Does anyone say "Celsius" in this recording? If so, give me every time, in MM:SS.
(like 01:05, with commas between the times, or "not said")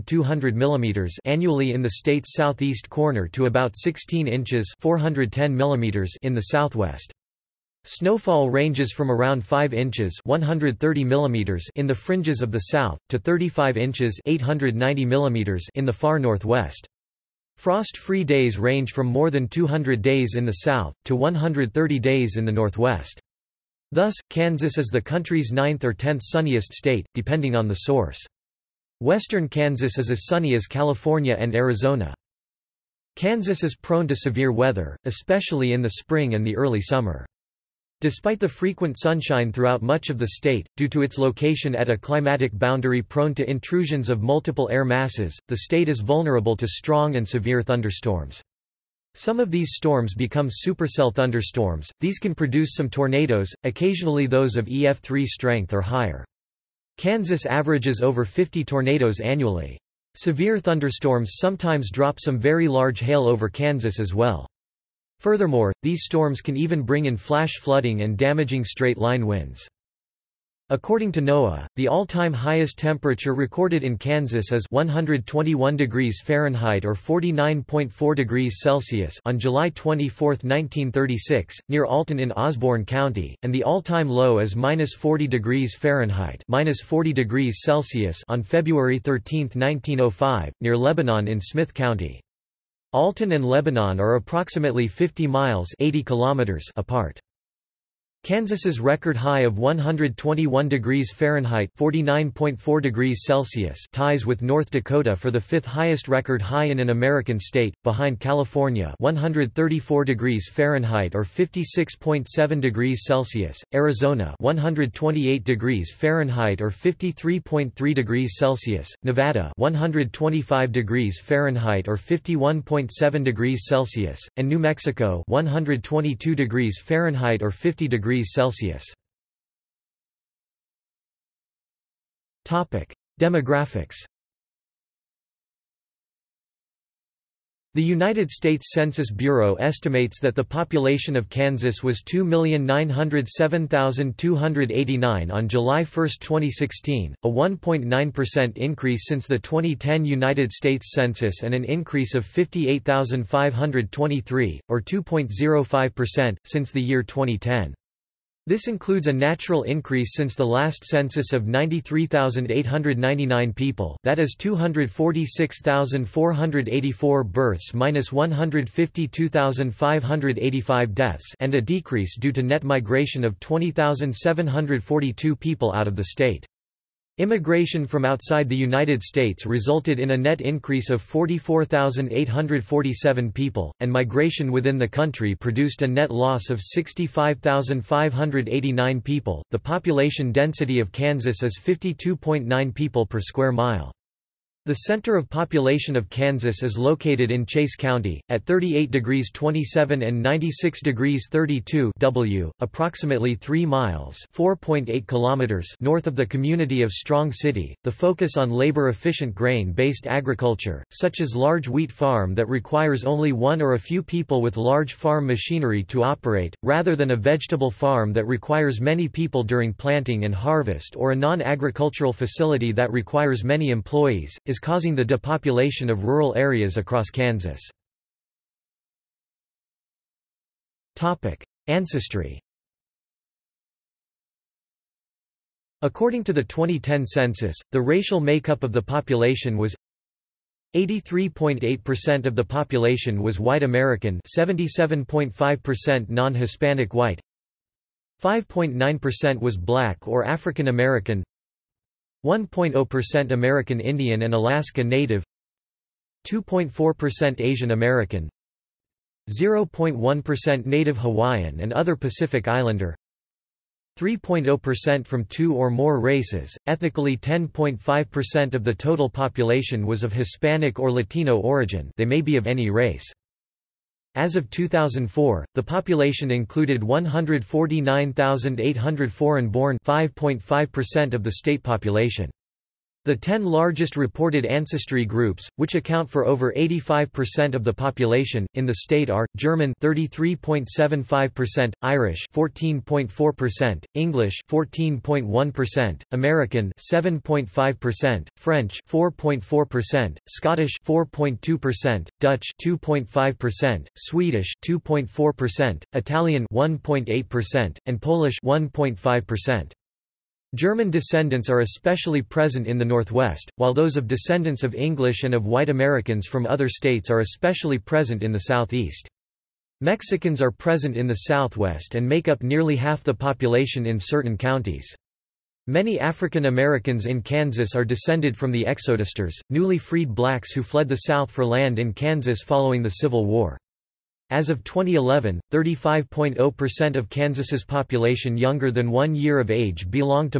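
01:18, 01:27.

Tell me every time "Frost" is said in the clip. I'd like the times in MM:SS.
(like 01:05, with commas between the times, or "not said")
00:17.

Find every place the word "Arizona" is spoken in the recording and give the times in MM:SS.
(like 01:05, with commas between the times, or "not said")
00:31, 01:53.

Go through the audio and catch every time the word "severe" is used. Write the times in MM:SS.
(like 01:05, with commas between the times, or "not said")
00:34, 00:47, 01:00.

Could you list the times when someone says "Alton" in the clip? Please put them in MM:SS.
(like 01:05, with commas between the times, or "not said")
01:21, 01:32.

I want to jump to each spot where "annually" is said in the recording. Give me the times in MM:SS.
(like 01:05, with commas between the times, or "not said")
00:01, 00:59.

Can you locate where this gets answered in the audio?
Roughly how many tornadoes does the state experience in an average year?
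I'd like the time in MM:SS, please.
00:58.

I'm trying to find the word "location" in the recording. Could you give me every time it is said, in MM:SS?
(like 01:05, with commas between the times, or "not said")
00:41.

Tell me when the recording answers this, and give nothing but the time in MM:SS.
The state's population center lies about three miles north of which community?
03:26.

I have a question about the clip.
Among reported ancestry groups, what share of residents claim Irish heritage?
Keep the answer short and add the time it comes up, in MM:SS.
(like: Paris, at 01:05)
14.4%, at 04:51.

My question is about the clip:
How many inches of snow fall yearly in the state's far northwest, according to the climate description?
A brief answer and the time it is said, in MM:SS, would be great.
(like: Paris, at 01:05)
35 inches, at 00:13.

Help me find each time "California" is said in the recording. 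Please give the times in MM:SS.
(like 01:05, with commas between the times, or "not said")
00:30, 01:48.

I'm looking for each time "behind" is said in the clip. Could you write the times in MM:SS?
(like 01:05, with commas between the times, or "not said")
01:47.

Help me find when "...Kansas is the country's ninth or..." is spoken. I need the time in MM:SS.
00:24.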